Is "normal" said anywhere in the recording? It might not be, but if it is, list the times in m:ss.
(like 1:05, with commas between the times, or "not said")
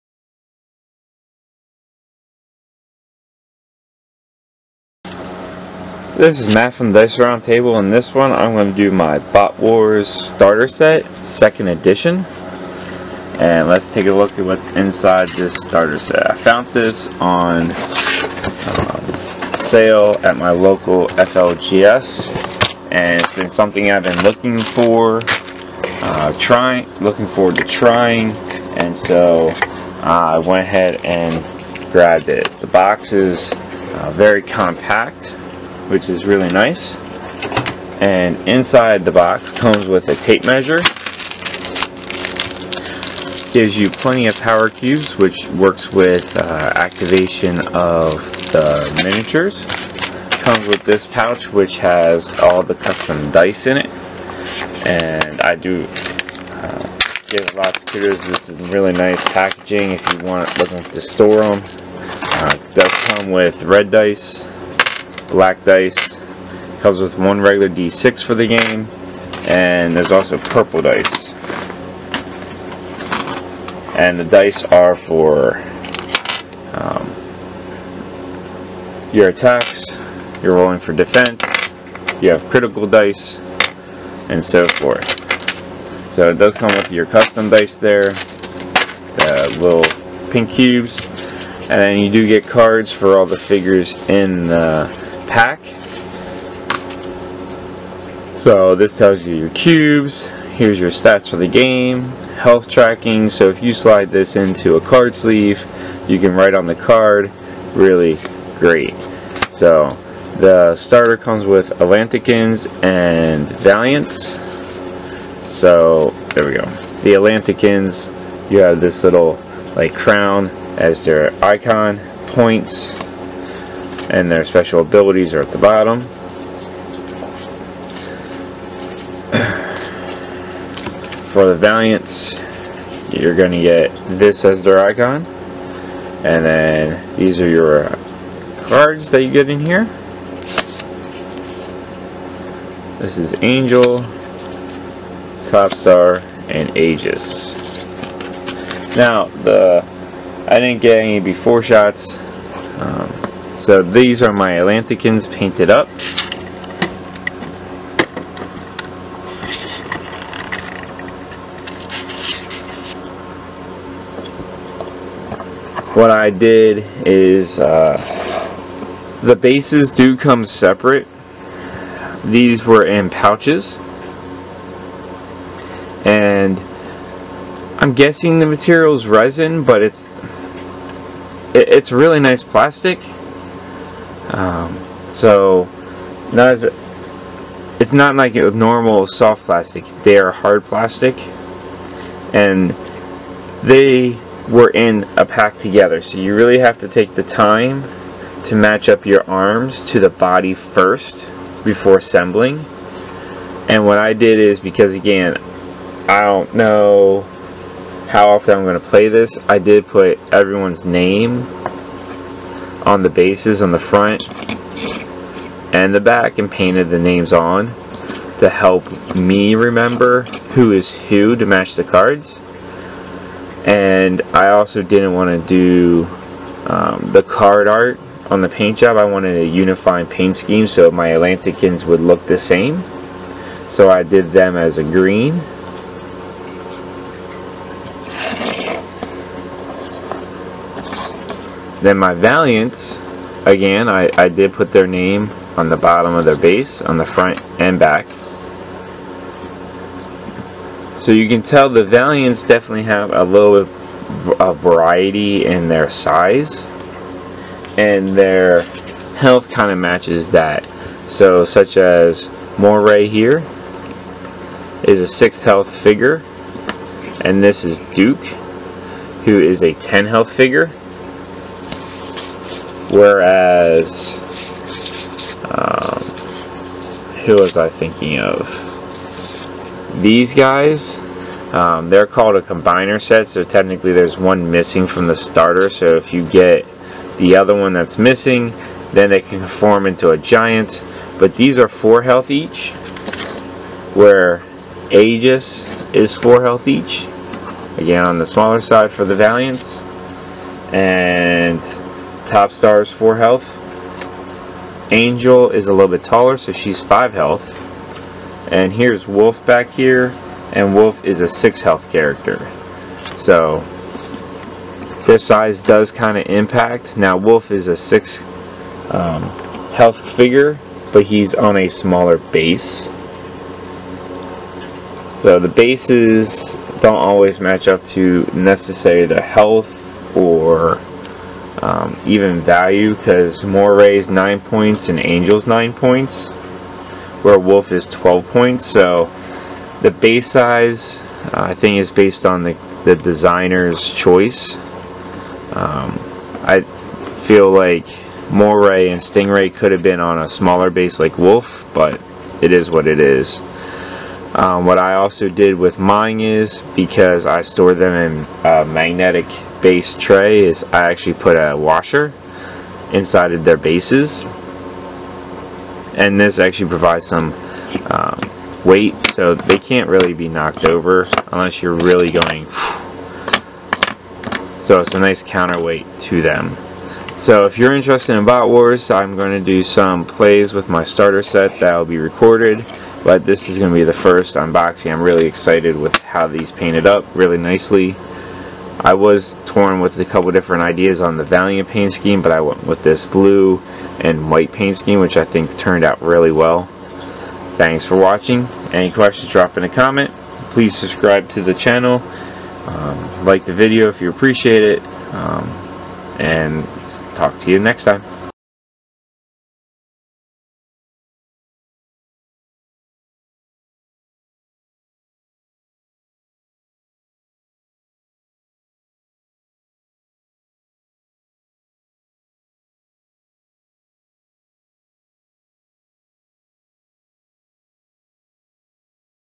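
3:08.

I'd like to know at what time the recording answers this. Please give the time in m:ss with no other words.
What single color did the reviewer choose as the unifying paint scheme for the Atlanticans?
3:54.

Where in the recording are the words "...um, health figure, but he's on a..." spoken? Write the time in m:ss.
5:18.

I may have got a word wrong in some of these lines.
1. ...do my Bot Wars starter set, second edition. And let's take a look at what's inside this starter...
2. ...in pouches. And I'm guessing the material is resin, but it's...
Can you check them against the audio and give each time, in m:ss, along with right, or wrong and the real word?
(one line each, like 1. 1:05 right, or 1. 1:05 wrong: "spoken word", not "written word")
1. 0:08 right
2. 2:52 right.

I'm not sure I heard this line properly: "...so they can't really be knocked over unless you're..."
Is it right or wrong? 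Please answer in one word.
right.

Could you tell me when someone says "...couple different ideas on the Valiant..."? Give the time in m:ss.
6:30.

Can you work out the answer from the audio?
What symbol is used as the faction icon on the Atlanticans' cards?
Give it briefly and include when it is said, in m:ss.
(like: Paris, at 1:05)
crown, at 1:59.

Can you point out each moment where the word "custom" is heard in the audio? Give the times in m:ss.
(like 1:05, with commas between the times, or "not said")
0:52, 1:27.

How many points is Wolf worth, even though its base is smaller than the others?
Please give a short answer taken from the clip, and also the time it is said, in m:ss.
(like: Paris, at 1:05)
12, at 5:37.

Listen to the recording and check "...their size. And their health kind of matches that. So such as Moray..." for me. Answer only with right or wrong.
right.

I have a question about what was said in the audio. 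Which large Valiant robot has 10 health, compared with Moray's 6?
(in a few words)
Duke.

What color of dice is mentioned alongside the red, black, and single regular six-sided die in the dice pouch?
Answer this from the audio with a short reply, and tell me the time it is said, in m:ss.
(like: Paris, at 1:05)
purple, at 1:10.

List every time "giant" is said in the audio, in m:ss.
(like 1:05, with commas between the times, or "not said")
4:50.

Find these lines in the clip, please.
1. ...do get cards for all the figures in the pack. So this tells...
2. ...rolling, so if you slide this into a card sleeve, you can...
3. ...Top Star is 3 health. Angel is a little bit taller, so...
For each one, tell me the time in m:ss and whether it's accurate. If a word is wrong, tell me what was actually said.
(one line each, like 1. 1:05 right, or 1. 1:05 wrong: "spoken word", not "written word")
1. 1:32 right
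2. 1:42 wrong: "tracking", not "rolling"
3. 5:02 wrong: "4", not "3".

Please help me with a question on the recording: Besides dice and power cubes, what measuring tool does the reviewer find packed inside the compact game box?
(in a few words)
tape measure.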